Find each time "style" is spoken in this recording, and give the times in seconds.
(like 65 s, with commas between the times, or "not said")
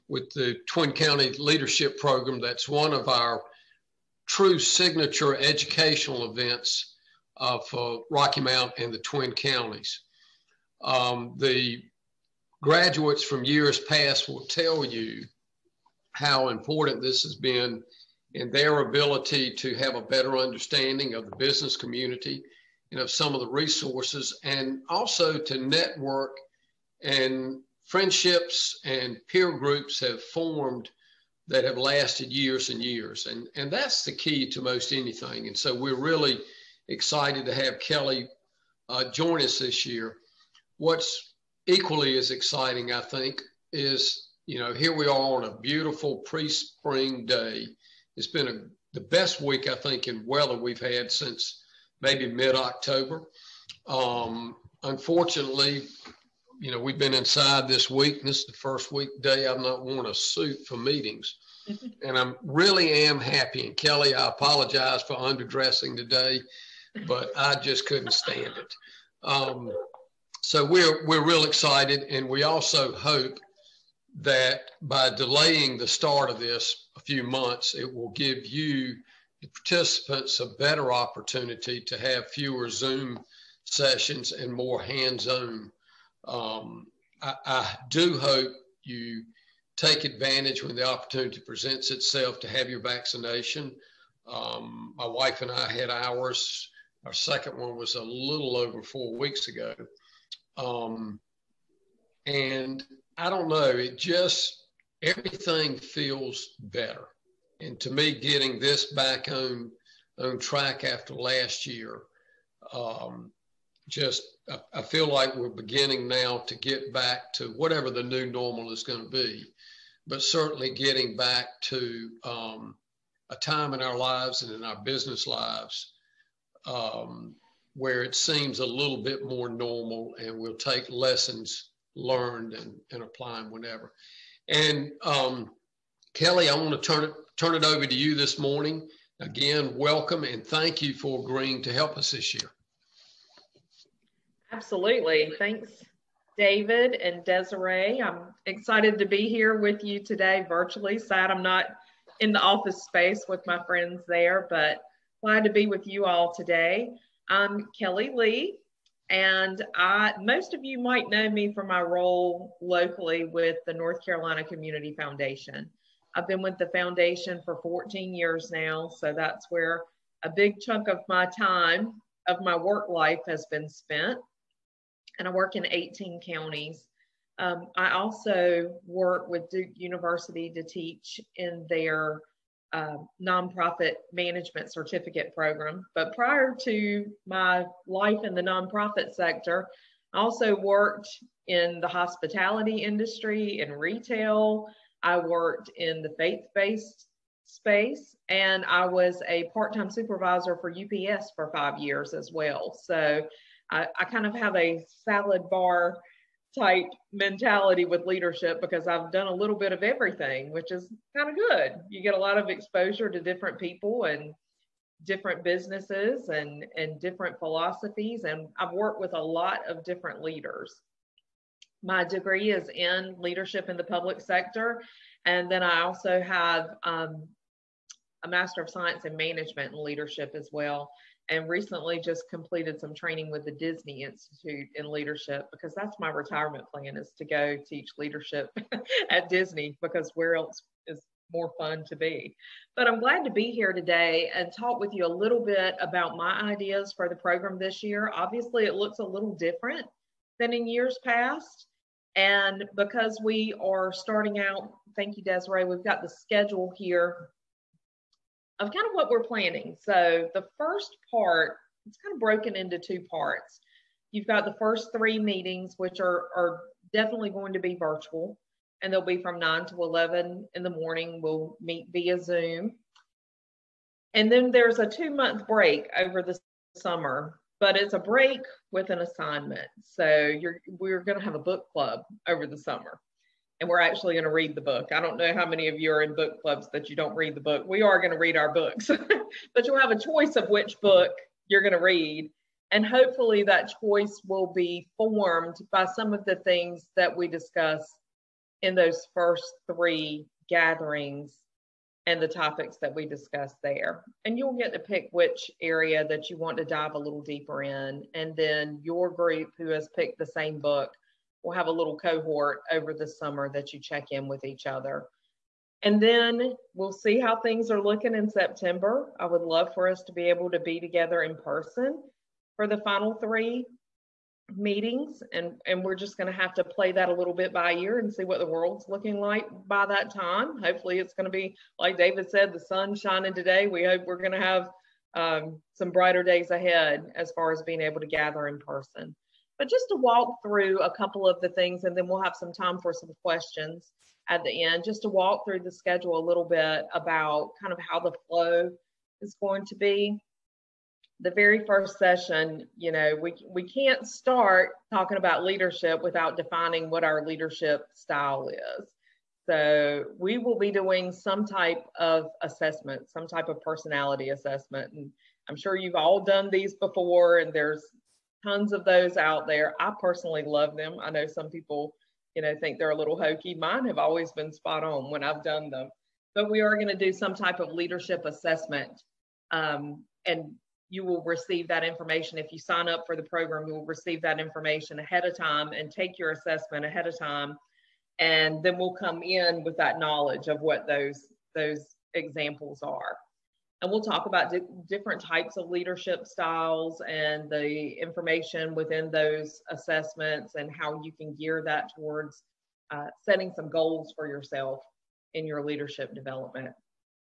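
357 s, 396 s.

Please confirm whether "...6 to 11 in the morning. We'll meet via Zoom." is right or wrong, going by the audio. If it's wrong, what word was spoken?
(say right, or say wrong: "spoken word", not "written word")
wrong: "9", not "6".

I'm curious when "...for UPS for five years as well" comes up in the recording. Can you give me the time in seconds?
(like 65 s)
200 s.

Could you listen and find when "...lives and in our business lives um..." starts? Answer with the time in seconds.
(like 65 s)
123 s.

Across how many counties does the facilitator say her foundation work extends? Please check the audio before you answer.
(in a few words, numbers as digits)
18.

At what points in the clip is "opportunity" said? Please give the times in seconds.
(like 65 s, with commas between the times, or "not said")
80 s, 90 s.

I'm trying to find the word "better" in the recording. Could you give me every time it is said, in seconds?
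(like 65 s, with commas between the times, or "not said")
20 s, 80 s, 106 s.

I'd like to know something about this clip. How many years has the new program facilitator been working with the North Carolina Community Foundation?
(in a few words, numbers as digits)
14 years.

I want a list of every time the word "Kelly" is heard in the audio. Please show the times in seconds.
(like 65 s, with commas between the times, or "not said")
37 s, 63 s, 136 s, 157 s.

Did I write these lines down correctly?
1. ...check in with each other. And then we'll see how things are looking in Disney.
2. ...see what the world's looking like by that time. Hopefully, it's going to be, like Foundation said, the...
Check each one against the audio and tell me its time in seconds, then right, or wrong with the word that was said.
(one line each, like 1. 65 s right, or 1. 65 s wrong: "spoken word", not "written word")
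1. 313 s wrong: "September", not "Disney"
2. 328 s wrong: "David", not "Foundation".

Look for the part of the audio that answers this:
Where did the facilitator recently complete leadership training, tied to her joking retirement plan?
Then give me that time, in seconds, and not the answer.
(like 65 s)
233 s.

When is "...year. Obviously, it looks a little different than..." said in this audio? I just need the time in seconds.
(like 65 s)
247 s.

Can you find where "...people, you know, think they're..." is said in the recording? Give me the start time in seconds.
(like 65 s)
371 s.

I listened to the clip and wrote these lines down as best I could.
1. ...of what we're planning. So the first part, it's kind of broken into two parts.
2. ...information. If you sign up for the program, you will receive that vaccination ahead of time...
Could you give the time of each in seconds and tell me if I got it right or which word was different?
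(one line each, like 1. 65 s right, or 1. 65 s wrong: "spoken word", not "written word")
1. 258 s right
2. 381 s wrong: "information", not "vaccination".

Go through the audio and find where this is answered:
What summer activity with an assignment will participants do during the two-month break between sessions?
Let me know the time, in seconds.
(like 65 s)
281 s.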